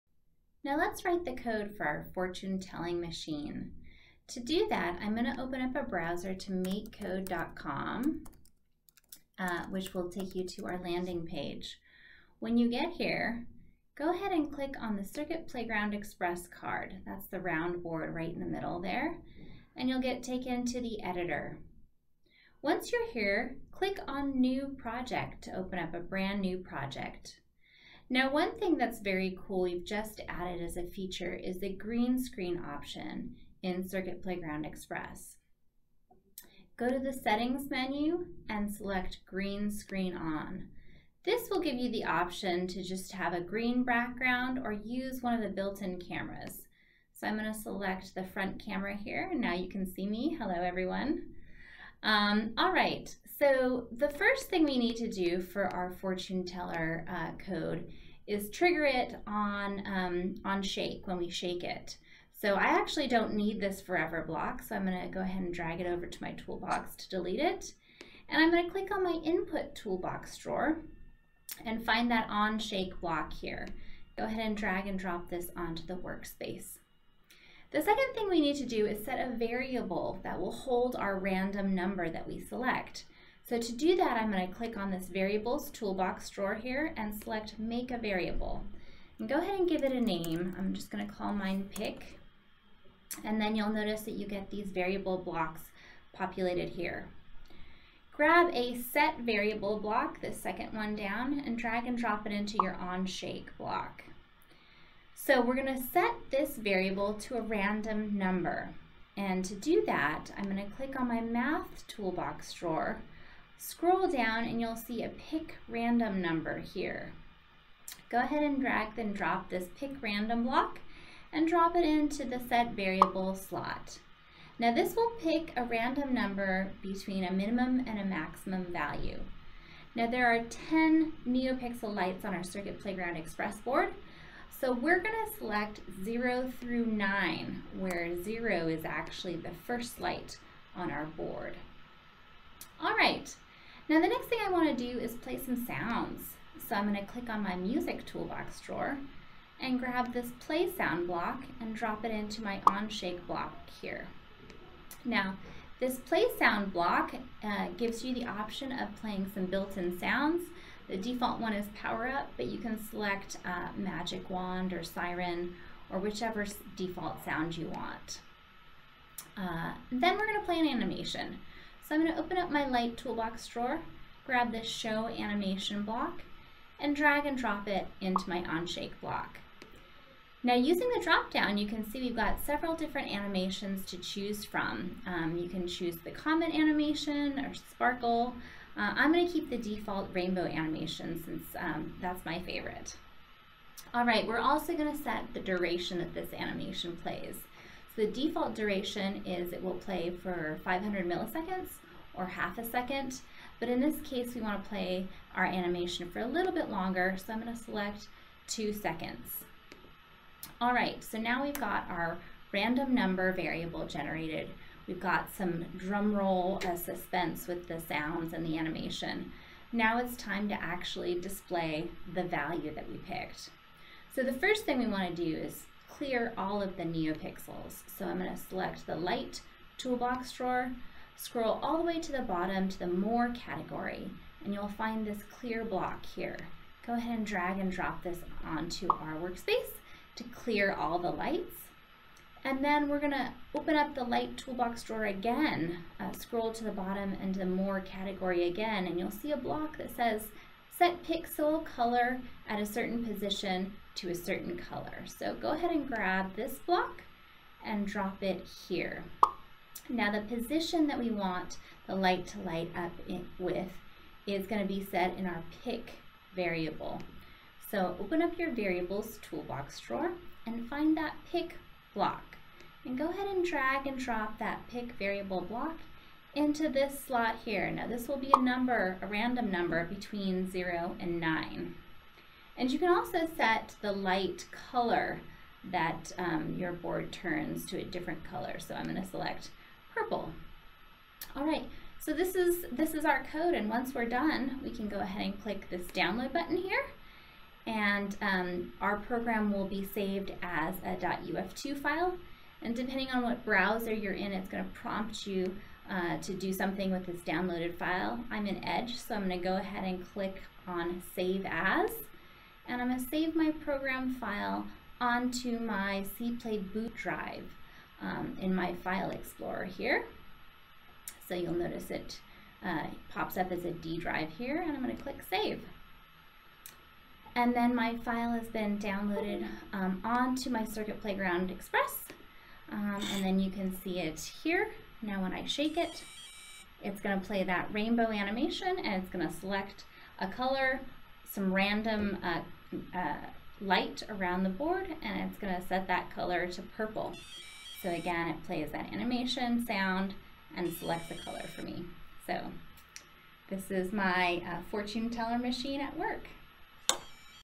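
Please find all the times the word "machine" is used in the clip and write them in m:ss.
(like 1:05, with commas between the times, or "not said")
0:03, 5:55.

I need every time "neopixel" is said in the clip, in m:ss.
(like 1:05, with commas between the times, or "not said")
2:11, 3:46.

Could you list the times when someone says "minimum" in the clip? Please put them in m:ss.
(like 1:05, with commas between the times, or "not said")
2:07.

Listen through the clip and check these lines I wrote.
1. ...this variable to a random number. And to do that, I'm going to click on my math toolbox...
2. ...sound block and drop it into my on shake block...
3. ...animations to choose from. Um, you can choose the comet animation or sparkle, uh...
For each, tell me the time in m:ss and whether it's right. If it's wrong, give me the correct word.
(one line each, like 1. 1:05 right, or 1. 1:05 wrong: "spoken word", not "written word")
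1. 1:46 right
2. 2:30 right
3. 3:03 right.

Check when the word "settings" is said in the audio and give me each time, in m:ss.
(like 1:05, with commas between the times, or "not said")
0:37.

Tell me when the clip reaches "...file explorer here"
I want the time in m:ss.
5:18.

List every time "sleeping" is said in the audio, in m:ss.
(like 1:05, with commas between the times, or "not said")
not said.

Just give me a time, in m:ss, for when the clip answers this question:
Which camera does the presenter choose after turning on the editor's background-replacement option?
0:48.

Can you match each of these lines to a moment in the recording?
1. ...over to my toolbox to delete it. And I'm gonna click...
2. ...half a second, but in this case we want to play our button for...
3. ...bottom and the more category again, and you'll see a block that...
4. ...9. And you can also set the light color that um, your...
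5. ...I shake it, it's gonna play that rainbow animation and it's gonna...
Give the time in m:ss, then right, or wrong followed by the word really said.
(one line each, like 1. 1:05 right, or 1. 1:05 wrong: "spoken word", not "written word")
1. 1:05 right
2. 3:22 wrong: "animation", not "button"
3. 4:06 right
4. 4:41 right
5. 5:35 right.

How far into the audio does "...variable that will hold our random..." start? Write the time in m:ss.
1:19.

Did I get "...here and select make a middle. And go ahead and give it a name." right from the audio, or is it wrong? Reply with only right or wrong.
wrong.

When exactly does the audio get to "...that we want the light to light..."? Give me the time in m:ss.
4:20.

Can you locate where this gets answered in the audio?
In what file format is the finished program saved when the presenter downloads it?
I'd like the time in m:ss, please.
5:00.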